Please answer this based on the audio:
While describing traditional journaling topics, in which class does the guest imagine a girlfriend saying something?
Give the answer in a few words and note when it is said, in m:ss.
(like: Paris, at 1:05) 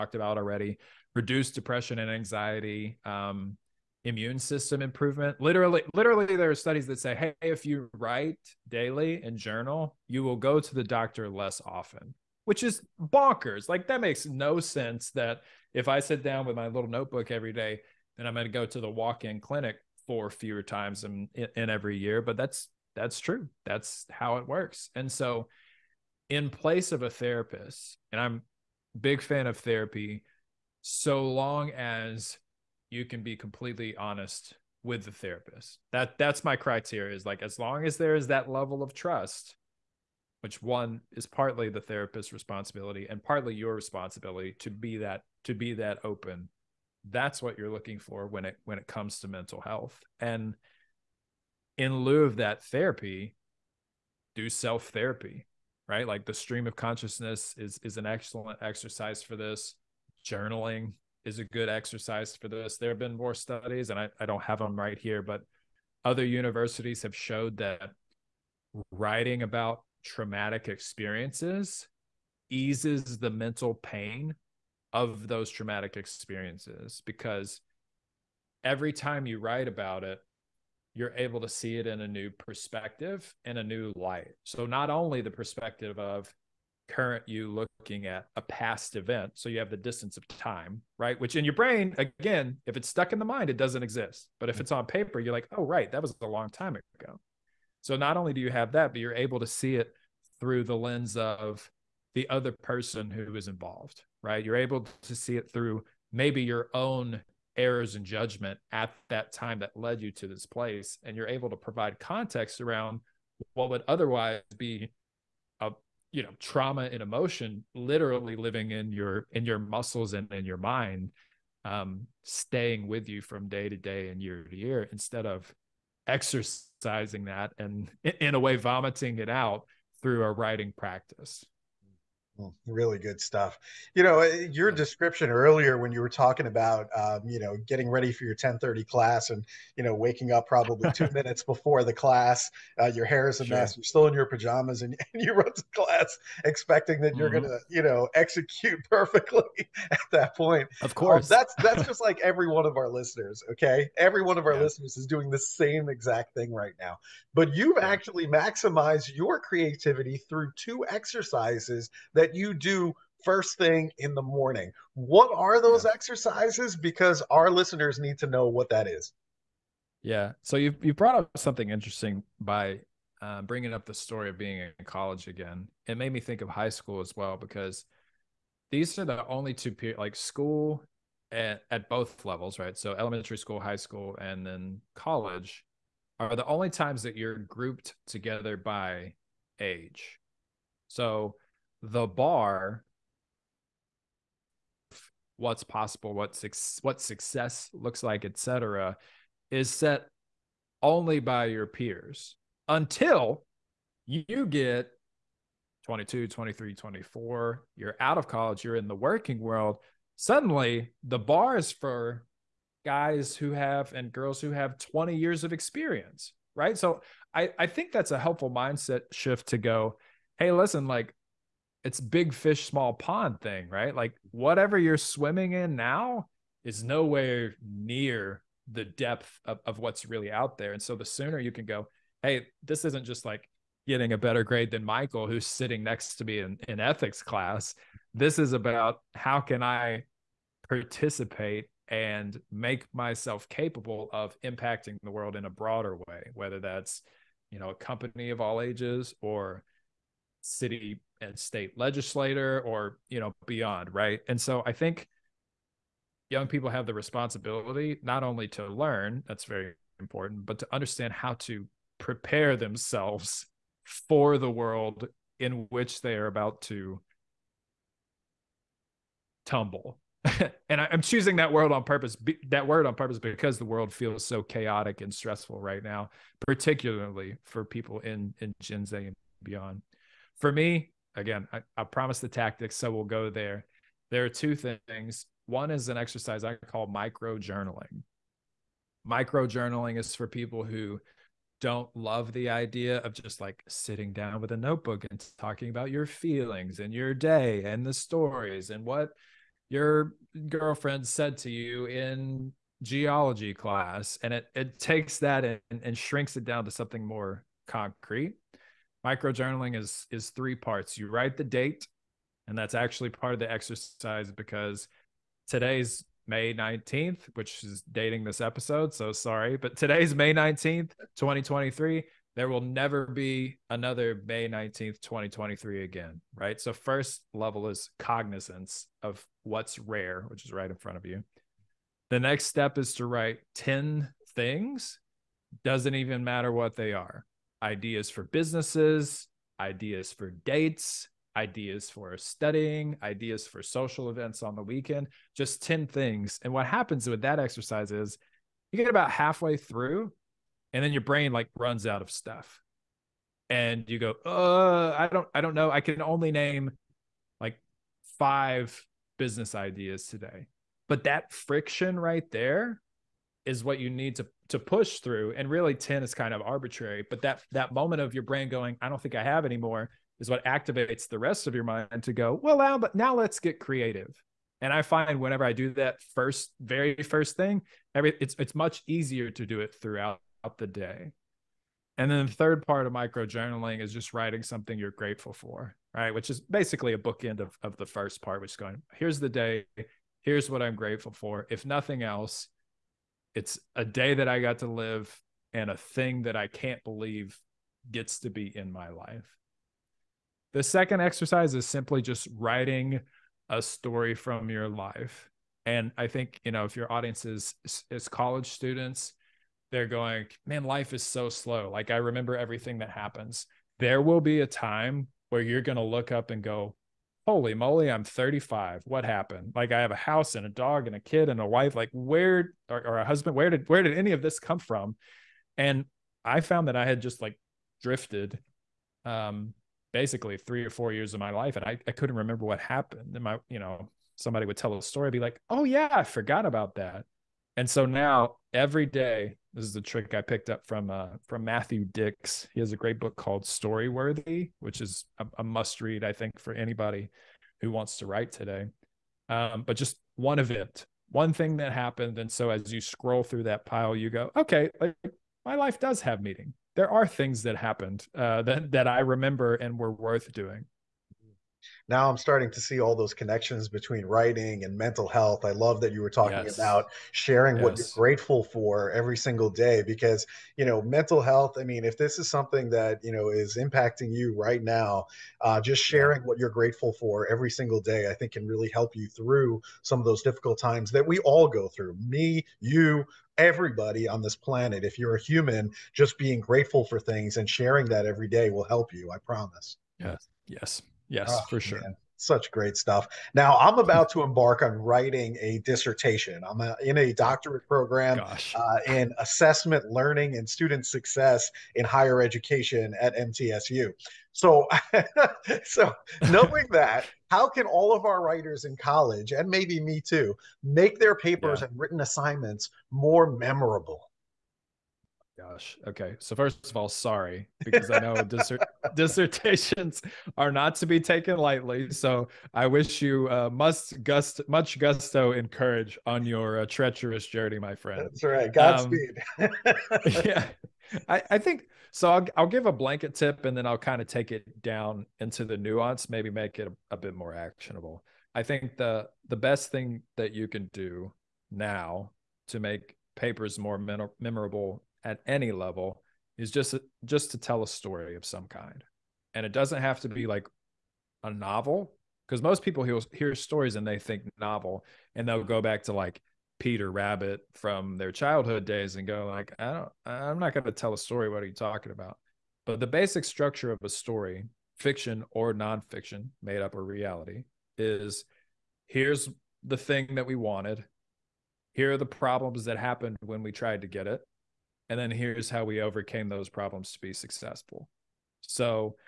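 Geology, at 5:02.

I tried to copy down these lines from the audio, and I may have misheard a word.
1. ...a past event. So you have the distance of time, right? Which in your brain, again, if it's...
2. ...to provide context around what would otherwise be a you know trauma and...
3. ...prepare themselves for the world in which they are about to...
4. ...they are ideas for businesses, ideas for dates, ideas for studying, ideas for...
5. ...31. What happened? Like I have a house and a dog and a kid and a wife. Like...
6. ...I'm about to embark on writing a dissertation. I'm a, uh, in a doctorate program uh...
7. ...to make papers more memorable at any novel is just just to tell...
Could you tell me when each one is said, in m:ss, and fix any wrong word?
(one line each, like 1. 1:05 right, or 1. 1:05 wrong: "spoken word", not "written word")
1. 1:28 right
2. 1:51 right
3. 4:21 right
4. 5:36 right
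5. 6:58 wrong: "35", not "31"
6. 8:13 right
7. 9:02 wrong: "level", not "novel".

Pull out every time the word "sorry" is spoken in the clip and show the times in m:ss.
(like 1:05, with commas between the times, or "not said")
5:19, 8:36.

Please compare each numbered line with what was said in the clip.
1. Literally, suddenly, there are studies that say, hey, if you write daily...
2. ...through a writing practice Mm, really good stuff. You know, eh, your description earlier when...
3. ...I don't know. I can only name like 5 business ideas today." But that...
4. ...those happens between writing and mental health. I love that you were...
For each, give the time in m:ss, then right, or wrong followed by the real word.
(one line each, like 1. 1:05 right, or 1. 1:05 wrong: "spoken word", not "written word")
1. 0:05 wrong: "literally", not "suddenly"
2. 2:10 right
3. 5:55 right
4. 7:42 wrong: "connections", not "happens".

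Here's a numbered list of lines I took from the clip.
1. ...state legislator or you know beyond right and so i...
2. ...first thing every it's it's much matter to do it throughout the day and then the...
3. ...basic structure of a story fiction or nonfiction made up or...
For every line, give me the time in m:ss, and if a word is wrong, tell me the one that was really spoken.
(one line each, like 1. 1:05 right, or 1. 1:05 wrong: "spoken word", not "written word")
1. 4:11 right
2. 6:16 wrong: "easier", not "matter"
3. 9:22 right.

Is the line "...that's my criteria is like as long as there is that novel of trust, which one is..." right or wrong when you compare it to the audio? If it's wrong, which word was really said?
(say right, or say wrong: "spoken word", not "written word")
wrong: "level", not "novel".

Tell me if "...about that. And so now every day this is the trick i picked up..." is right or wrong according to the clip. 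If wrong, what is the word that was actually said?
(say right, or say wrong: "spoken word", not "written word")
right.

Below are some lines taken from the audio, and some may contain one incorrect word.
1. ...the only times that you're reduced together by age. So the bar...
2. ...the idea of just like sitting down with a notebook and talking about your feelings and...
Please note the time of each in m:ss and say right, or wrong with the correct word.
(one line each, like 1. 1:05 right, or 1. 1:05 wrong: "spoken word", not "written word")
1. 3:06 wrong: "grouped", not "reduced"
2. 4:52 right.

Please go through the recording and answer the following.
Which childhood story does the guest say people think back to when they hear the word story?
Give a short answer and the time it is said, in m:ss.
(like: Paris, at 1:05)
Peter Rabbit, at 9:16.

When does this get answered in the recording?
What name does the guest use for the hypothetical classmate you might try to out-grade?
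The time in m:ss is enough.
3:54.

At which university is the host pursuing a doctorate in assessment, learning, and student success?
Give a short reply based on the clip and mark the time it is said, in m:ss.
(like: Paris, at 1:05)
MTSU, at 8:23.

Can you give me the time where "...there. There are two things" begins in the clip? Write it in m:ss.
4:43.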